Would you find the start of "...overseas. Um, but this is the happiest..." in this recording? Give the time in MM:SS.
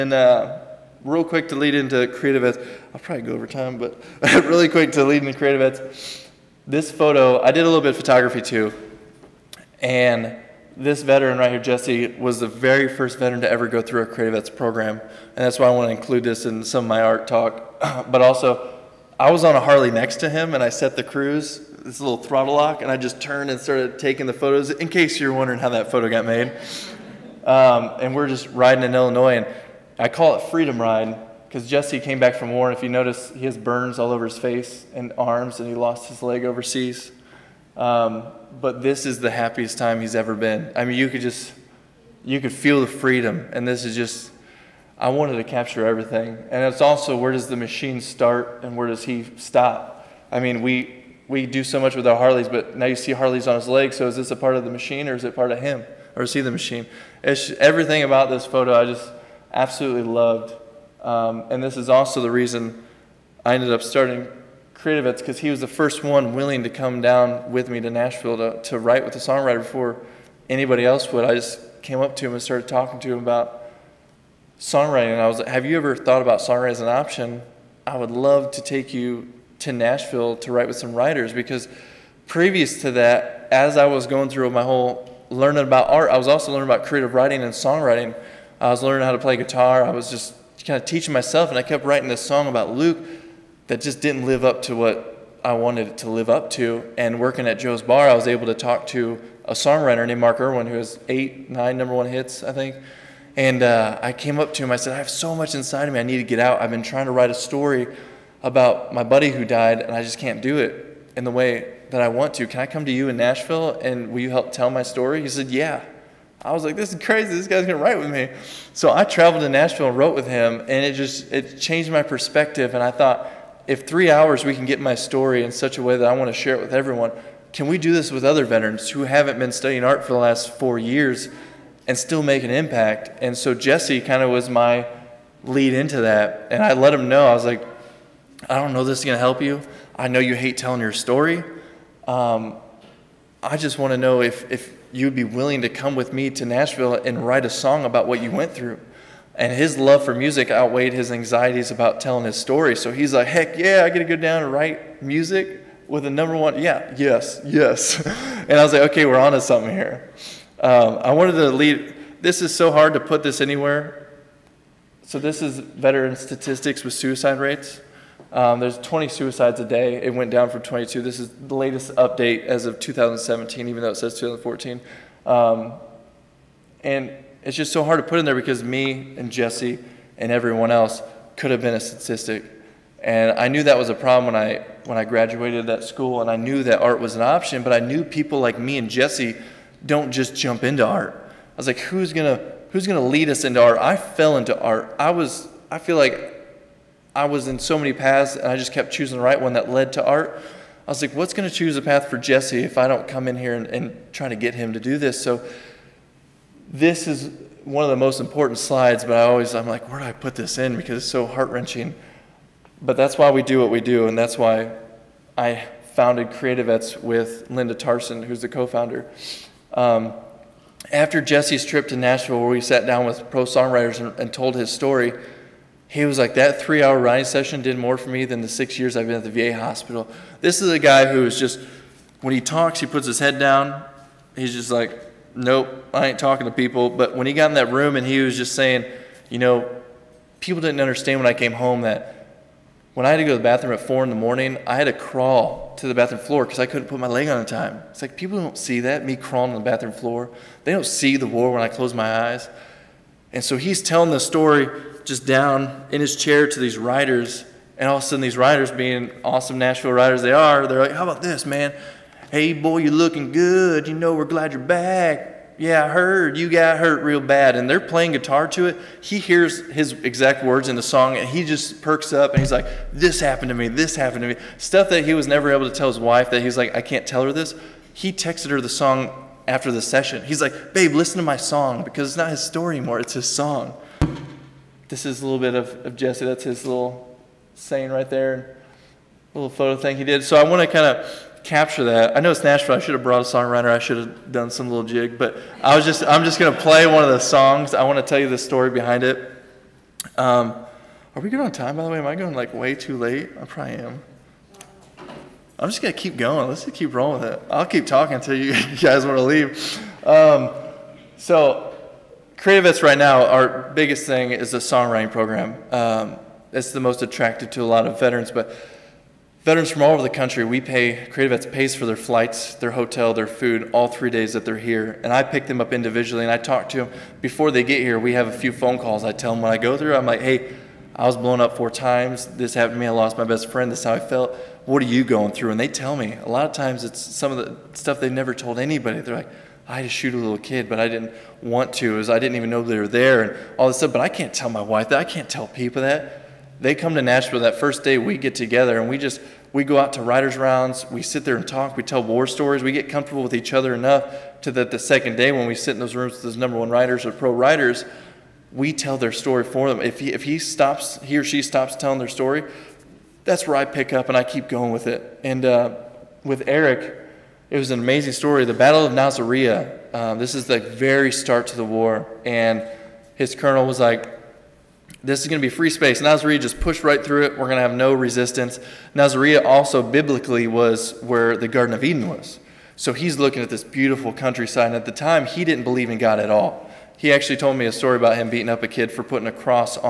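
00:36.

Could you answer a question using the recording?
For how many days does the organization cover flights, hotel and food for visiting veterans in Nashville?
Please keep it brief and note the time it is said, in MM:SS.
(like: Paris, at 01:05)
3, at 05:23.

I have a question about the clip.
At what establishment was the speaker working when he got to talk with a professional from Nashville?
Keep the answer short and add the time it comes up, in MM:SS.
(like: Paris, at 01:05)
Joe's Bar, at 01:37.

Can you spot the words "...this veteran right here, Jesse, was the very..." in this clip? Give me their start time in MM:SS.
00:10.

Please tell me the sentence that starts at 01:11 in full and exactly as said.
I just came up to him and started talking to him about songwriting.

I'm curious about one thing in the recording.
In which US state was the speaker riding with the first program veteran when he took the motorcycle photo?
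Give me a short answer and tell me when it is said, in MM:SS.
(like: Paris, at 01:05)
Illinois, at 00:28.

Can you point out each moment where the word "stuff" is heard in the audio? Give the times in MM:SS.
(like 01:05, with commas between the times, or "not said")
04:34, 05:37, 05:43.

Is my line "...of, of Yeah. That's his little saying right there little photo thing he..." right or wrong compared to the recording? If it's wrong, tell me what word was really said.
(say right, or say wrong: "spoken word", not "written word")
wrong: "Jesse", not "Yeah".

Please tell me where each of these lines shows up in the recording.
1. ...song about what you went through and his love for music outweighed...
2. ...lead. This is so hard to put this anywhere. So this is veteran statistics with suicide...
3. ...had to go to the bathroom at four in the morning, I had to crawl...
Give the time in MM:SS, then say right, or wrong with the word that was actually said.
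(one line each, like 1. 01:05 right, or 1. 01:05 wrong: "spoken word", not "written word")
1. 02:27 right
2. 02:41 right
3. 04:03 right.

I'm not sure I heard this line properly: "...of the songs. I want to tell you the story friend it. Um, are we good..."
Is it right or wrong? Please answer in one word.
wrong.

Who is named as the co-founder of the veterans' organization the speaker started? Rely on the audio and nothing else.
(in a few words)
Linda Tarson.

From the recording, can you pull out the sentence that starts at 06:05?
And uh, with Eric, it was an amazing story.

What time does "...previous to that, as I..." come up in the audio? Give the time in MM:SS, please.
01:22.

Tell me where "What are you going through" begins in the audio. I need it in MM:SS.
05:34.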